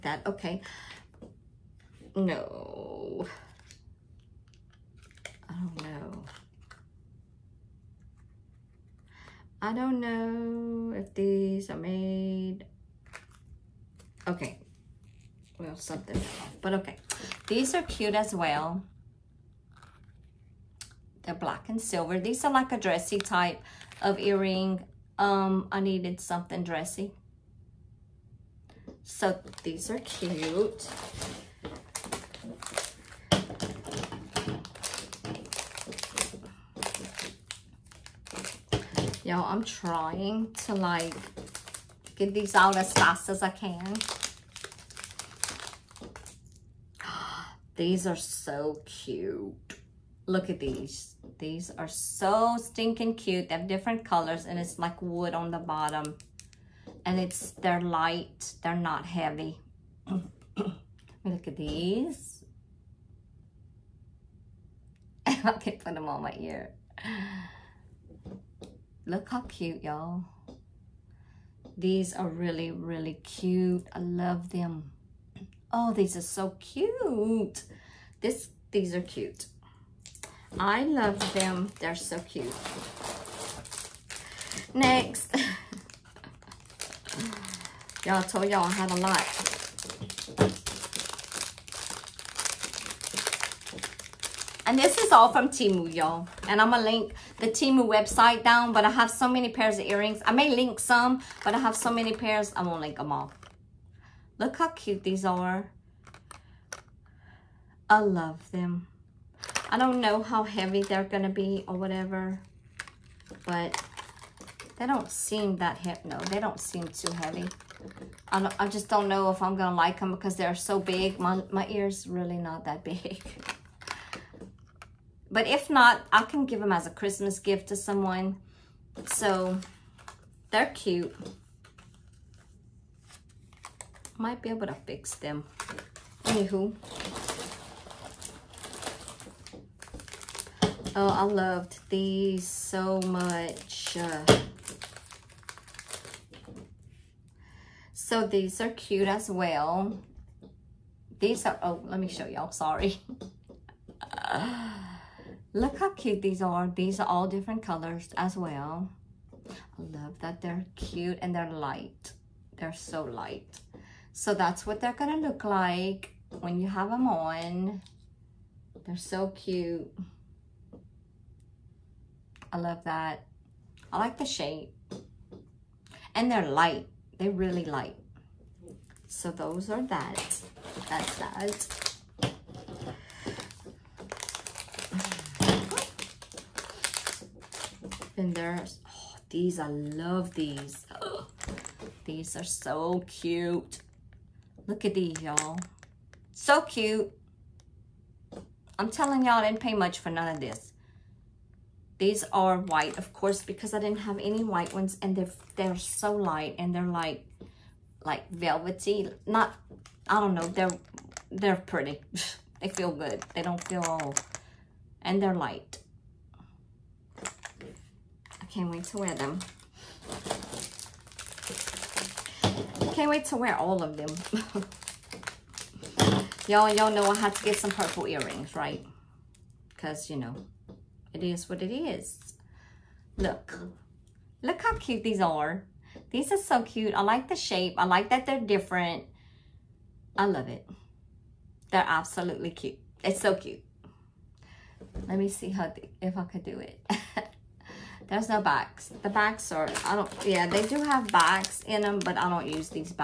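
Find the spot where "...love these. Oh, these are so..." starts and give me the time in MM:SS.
03:09.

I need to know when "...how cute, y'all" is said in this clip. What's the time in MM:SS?
01:09.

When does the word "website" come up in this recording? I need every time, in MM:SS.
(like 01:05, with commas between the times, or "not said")
01:37.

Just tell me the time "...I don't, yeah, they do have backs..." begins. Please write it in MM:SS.
04:09.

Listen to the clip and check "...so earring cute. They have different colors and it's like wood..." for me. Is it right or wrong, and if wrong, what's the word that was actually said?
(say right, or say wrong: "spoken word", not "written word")
wrong: "stinking", not "earring".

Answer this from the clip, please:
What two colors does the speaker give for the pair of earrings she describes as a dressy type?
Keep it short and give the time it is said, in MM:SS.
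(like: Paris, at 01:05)
black and silver, at 00:21.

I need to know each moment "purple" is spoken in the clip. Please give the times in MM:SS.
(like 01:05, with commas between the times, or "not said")
03:47.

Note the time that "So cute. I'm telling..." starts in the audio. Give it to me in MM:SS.
03:16.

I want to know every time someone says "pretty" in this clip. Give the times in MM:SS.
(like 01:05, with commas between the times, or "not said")
03:31.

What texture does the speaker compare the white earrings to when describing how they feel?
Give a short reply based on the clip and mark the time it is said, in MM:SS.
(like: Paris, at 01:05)
velvety, at 03:28.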